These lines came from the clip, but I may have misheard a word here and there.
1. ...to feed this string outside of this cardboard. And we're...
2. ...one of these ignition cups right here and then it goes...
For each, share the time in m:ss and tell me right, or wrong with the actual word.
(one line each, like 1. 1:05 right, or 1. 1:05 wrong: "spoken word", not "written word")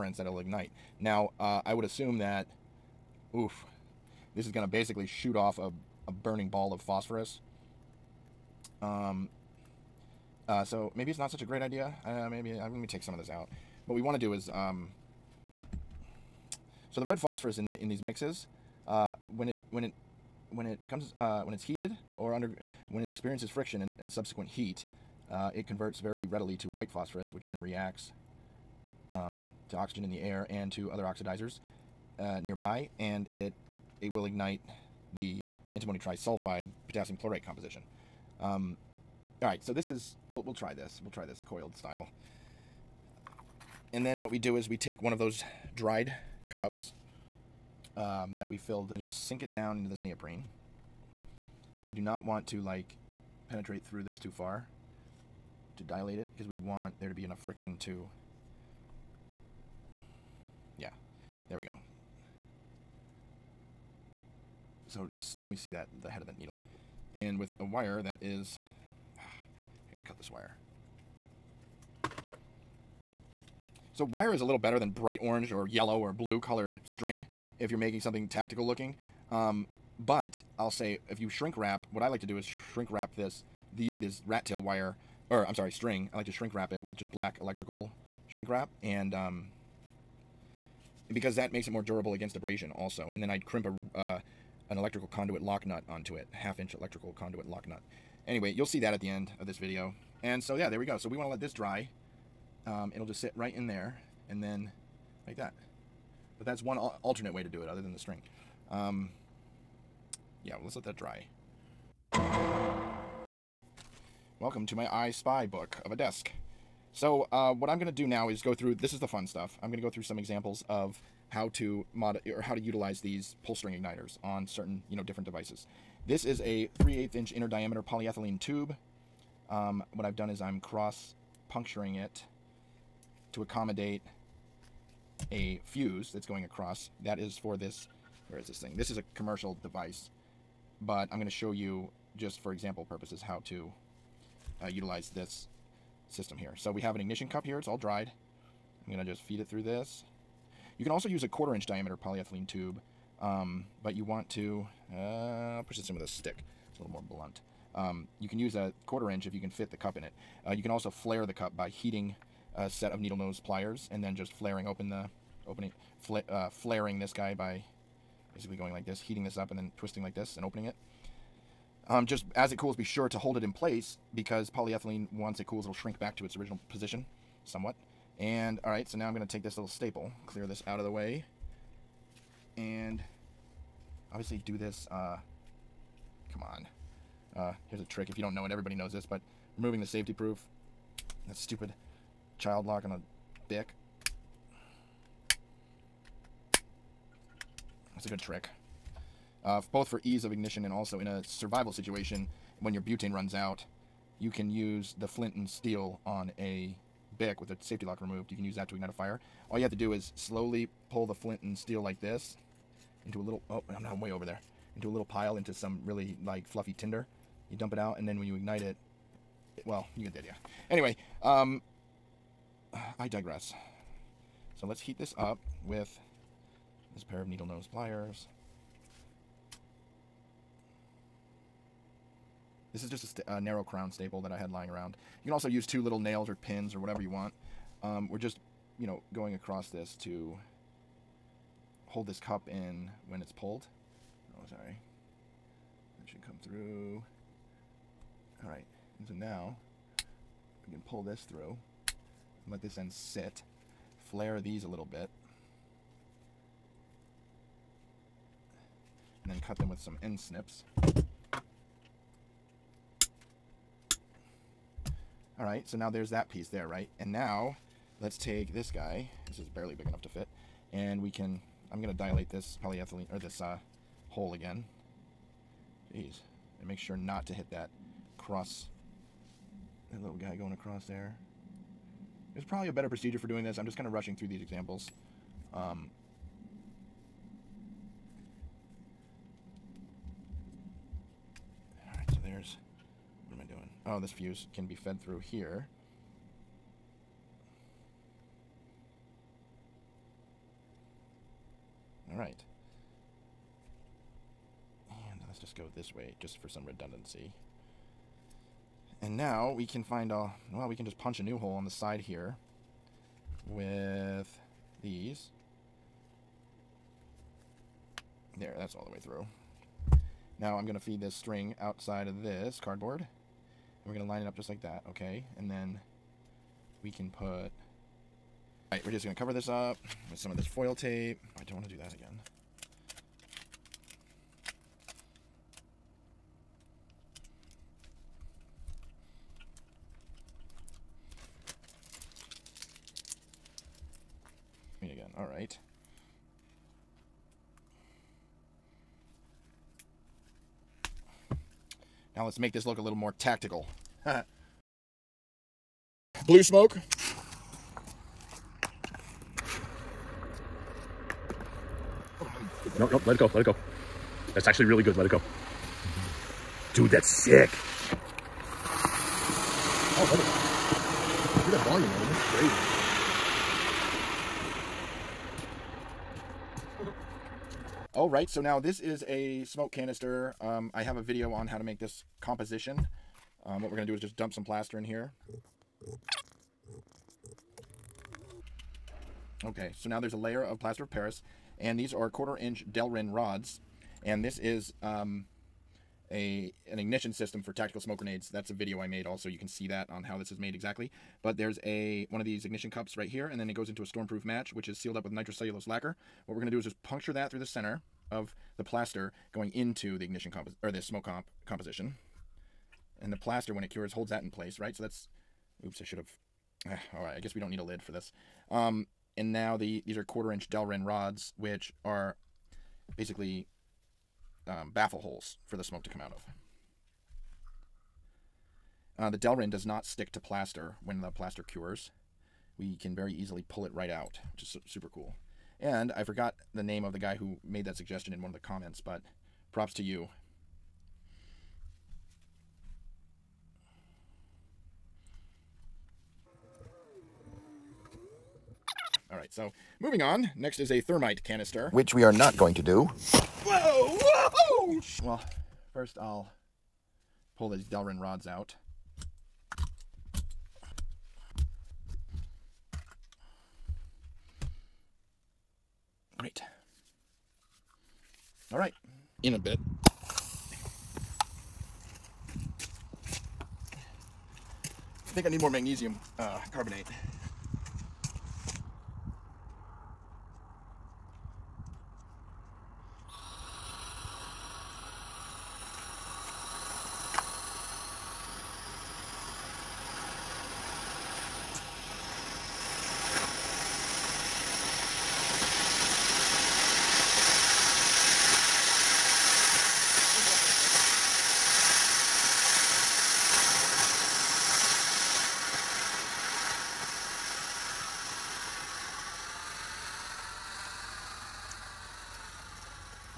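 1. 5:20 right
2. 6:42 right.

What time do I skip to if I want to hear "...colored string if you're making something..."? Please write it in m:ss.
1:16.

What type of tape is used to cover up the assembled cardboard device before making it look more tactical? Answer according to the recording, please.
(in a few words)
foil tape.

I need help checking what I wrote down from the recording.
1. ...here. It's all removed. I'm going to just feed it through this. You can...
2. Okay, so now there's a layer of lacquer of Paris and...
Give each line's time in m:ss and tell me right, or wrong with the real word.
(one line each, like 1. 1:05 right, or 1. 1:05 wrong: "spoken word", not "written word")
1. 2:27 wrong: "dried", not "removed"
2. 6:29 wrong: "plaster", not "lacquer".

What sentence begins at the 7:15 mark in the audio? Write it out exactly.
And I forgot the name of the guy who made that suggestion in one of the comments, but props to you.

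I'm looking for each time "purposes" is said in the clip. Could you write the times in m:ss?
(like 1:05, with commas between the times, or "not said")
2:22.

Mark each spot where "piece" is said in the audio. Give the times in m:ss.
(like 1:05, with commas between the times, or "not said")
4:26.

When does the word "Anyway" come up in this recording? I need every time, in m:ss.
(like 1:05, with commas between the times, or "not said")
1:38, 3:40.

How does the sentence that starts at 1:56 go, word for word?
So, uh, what I'm going to do now is go through, this is the fun stuff.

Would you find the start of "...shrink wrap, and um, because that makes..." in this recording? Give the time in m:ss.
1:28.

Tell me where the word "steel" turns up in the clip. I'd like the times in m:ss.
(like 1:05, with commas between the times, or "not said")
3:25, 3:31.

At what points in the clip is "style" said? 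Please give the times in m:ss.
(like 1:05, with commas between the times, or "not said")
0:41.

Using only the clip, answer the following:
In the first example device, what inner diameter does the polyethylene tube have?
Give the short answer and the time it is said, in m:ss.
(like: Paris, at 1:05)
3/8 inch, at 2:06.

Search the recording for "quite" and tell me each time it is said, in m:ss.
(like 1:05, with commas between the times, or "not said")
not said.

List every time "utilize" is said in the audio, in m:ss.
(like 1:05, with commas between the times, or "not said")
2:02, 2:24.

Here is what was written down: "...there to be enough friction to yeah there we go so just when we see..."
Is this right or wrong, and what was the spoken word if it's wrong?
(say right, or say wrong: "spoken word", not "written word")
right.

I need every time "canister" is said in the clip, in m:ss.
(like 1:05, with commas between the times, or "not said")
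6:19, 7:31.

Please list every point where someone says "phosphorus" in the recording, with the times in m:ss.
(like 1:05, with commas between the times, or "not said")
0:06, 0:17, 0:26.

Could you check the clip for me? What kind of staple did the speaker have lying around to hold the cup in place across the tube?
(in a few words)
narrow crown staple.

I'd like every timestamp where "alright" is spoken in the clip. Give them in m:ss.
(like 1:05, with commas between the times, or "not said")
2:58, 5:28.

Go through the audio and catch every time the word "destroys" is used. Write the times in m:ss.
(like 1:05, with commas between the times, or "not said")
not said.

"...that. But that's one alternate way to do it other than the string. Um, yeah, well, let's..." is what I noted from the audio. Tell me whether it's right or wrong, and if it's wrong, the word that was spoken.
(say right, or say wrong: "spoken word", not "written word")
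right.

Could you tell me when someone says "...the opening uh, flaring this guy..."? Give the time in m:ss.
2:44.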